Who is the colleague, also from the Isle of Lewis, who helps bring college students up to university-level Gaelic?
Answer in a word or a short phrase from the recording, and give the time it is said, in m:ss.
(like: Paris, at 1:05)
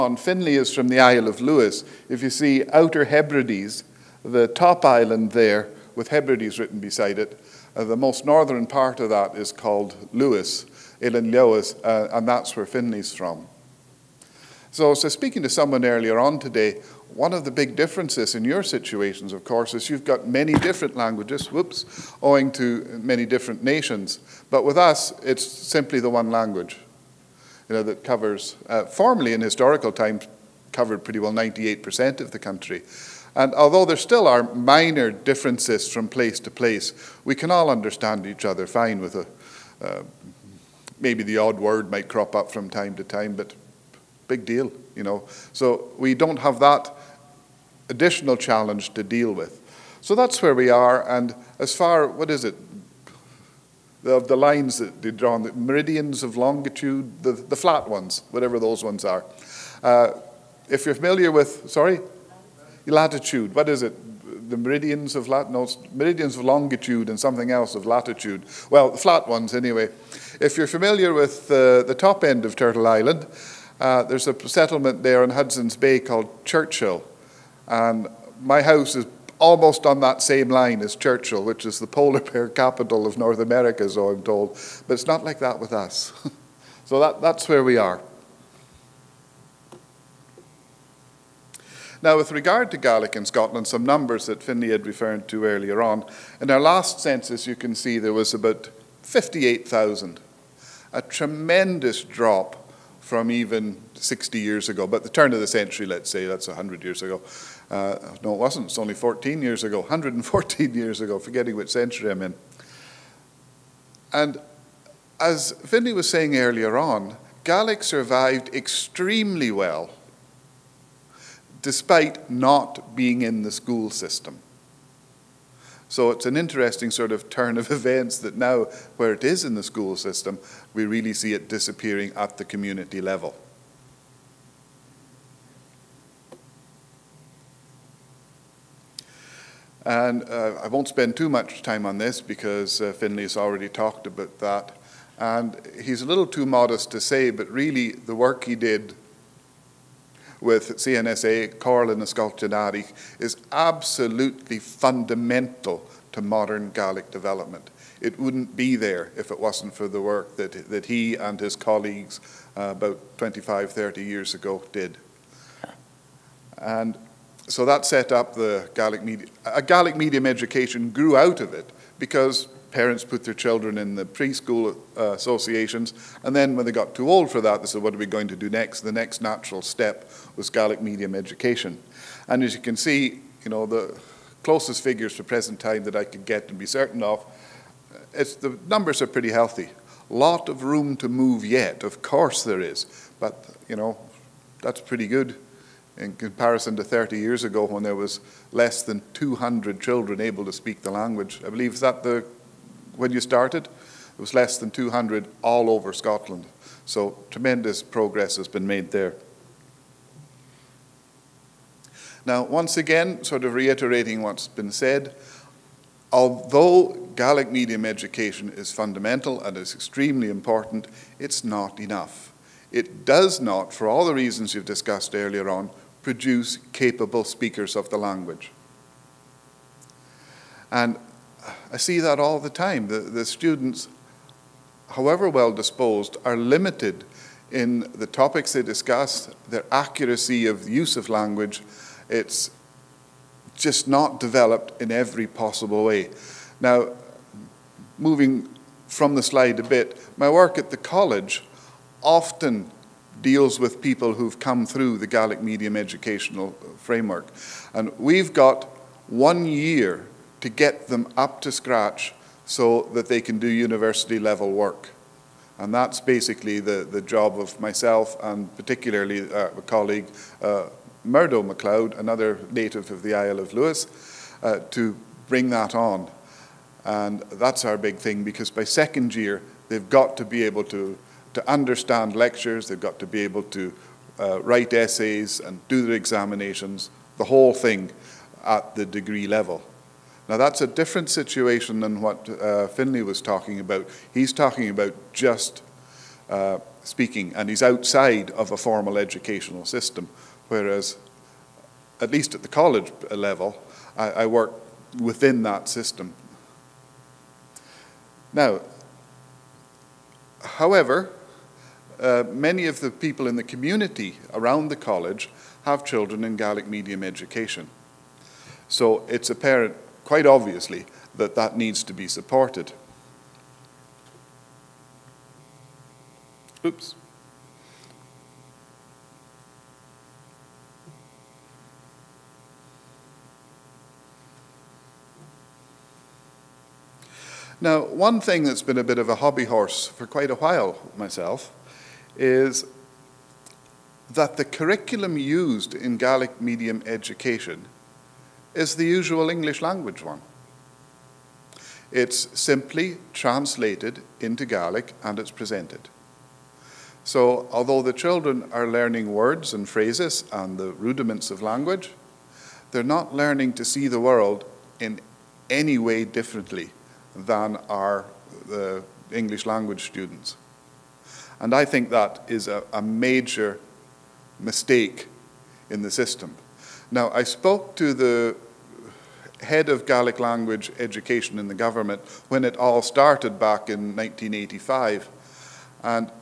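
Murdo MacLeod, at 4:31.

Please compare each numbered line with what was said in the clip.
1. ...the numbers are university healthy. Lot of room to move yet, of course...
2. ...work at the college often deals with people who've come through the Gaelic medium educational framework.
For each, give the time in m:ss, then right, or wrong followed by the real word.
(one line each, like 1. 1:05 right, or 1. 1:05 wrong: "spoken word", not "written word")
1. 3:08 wrong: "pretty", not "university"
2. 4:10 right.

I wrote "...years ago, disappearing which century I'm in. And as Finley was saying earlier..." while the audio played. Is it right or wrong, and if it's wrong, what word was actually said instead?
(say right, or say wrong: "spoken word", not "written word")
wrong: "forgetting", not "disappearing".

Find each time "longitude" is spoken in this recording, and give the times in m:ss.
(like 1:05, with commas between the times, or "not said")
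0:56, 1:06.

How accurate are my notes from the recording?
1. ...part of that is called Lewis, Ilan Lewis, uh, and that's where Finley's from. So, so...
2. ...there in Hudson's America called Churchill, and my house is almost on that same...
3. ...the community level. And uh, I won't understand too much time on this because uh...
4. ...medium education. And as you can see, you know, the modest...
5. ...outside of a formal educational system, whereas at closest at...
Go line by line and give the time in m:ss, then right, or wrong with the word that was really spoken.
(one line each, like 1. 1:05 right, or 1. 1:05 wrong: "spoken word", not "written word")
1. 0:08 right
2. 1:15 wrong: "Bay", not "America"
3. 2:12 wrong: "spend", not "understand"
4. 3:00 wrong: "closest", not "modest"
5. 4:57 wrong: "least", not "closest".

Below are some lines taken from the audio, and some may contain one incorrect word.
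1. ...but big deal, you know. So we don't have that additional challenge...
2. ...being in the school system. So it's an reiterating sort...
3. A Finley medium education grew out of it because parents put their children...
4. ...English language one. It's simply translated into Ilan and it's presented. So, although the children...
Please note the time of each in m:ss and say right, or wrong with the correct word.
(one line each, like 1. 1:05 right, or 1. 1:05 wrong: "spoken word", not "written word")
1. 0:43 right
2. 2:02 wrong: "interesting", not "reiterating"
3. 2:49 wrong: "Gaelic", not "Finley"
4. 5:49 wrong: "Gaelic", not "Ilan".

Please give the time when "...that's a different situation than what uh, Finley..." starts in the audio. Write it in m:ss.
4:50.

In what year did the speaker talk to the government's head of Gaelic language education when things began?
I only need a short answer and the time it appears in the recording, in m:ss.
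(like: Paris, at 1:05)
1985, at 6:23.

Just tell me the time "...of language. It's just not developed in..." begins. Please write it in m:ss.
4:00.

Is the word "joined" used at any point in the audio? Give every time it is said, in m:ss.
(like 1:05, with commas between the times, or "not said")
not said.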